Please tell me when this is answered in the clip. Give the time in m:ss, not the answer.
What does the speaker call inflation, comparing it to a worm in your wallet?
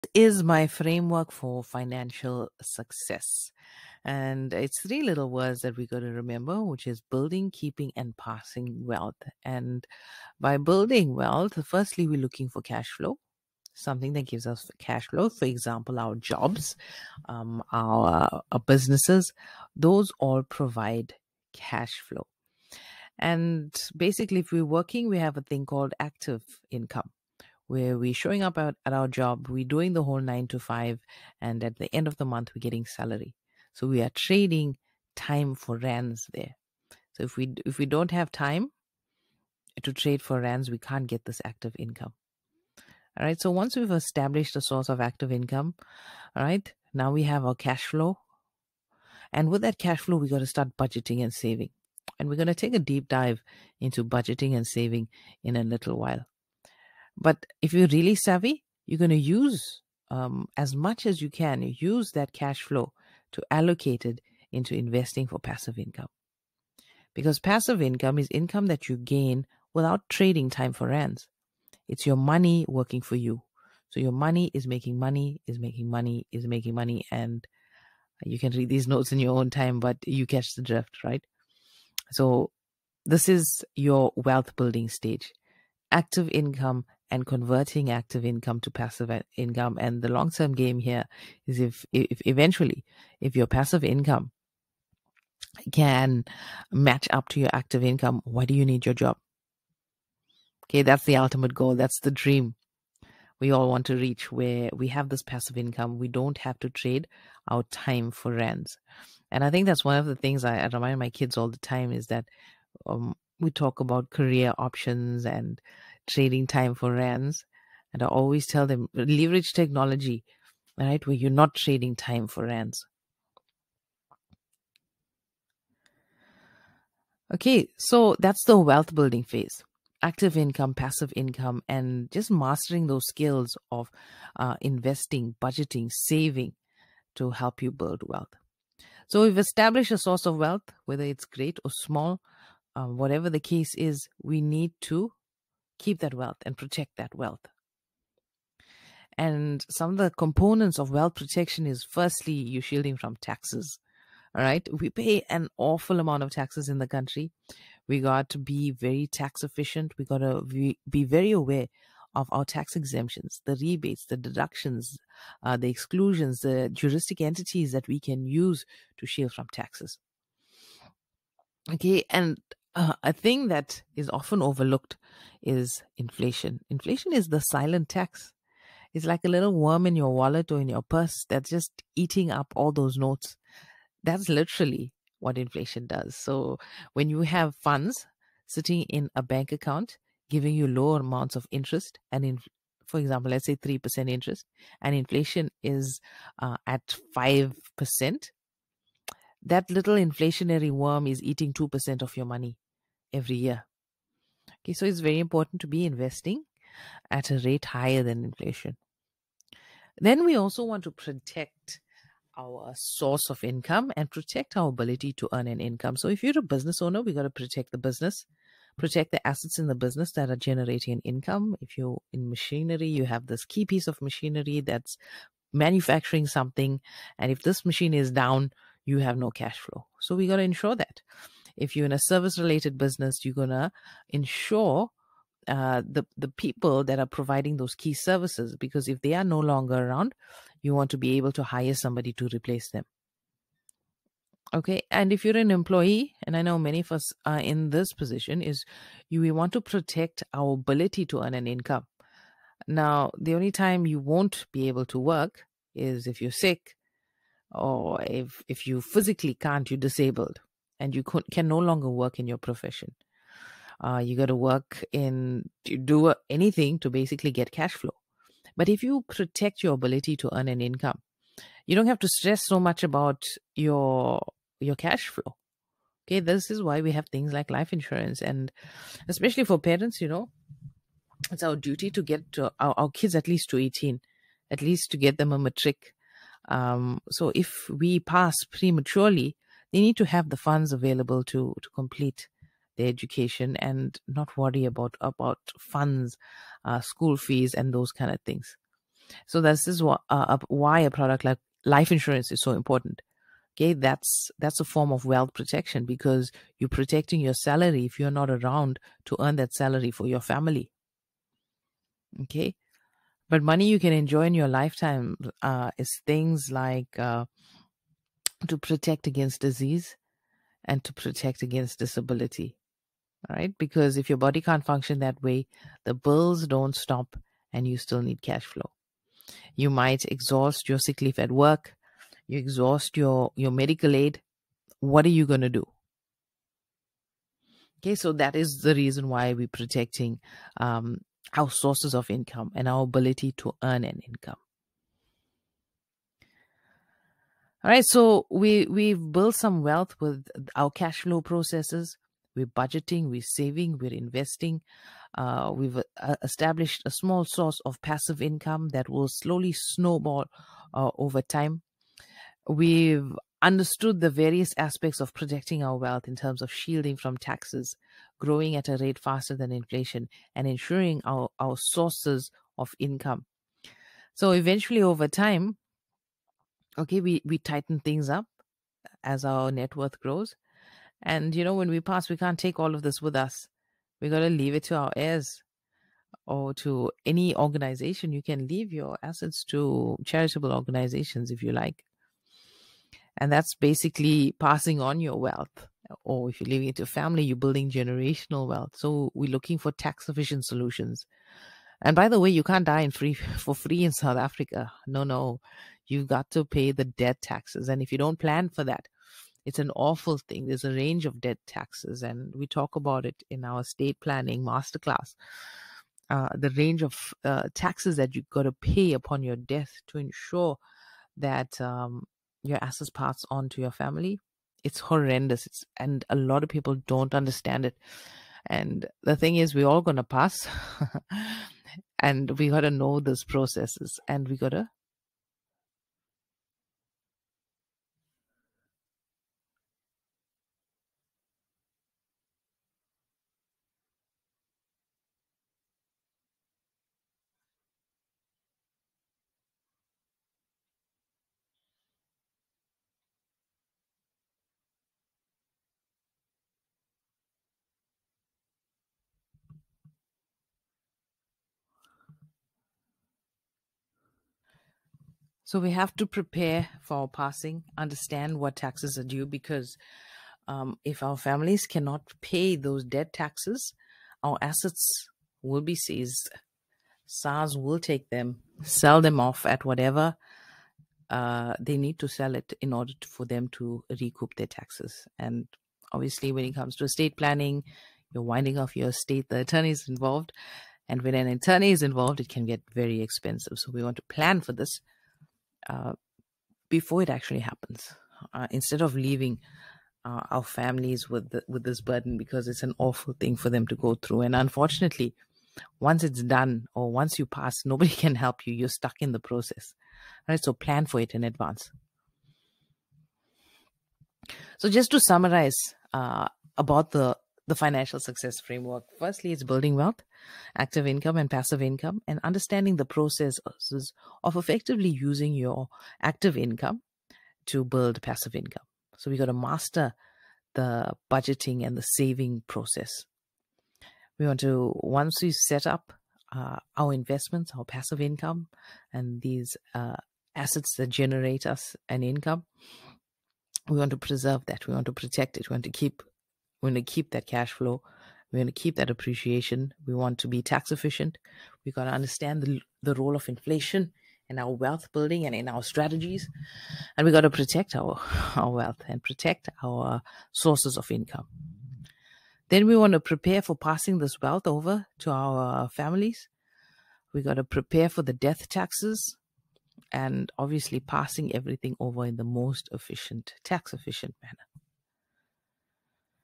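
2:57.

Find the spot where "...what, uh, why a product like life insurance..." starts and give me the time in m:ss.
4:59.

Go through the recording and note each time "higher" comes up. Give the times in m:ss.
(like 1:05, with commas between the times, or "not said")
3:27.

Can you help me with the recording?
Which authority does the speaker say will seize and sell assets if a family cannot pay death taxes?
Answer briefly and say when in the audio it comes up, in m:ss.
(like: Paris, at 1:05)
SARS, at 7:57.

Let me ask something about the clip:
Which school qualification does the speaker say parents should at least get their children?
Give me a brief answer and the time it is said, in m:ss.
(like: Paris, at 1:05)
matric, at 4:45.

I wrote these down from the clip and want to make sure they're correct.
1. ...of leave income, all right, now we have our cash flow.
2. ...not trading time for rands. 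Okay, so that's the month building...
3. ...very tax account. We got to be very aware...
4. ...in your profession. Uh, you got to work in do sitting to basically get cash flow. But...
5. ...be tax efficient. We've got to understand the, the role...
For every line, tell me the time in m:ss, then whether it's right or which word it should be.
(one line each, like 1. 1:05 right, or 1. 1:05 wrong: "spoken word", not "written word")
1. 0:44 wrong: "active", not "leave"
2. 2:01 wrong: "wealth", not "month"
3. 2:38 wrong: "efficient", not "account"
4. 4:22 wrong: "anything", not "sitting"
5. 9:10 right.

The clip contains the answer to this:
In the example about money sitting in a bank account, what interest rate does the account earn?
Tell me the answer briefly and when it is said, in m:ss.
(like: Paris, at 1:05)
3%, at 3:13.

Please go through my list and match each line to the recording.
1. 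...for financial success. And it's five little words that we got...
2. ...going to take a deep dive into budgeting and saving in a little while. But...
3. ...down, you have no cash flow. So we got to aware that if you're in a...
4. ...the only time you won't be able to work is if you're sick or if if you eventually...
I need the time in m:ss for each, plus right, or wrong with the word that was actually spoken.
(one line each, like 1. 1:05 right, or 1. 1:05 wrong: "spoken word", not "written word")
1. 0:01 wrong: "three", not "five"
2. 0:52 right
3. 3:48 wrong: "ensure", not "aware"
4. 4:13 wrong: "physically", not "eventually".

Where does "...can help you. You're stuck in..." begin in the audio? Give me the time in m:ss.
8:27.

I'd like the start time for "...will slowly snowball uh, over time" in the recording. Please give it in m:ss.
5:58.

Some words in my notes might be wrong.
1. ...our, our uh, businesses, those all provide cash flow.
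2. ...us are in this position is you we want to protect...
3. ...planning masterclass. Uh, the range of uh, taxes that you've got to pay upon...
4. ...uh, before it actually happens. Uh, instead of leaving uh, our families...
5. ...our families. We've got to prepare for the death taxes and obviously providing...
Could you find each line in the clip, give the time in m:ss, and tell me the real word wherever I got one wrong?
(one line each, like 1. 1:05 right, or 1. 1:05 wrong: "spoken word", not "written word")
1. 0:17 right
2. 4:06 right
3. 6:53 right
4. 8:15 right
5. 9:25 wrong: "passing", not "providing".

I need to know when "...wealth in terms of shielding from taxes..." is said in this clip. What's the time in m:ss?
6:05.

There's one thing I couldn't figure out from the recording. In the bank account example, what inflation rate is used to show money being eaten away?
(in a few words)
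5%.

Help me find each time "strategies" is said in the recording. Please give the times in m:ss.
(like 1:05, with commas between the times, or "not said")
9:15.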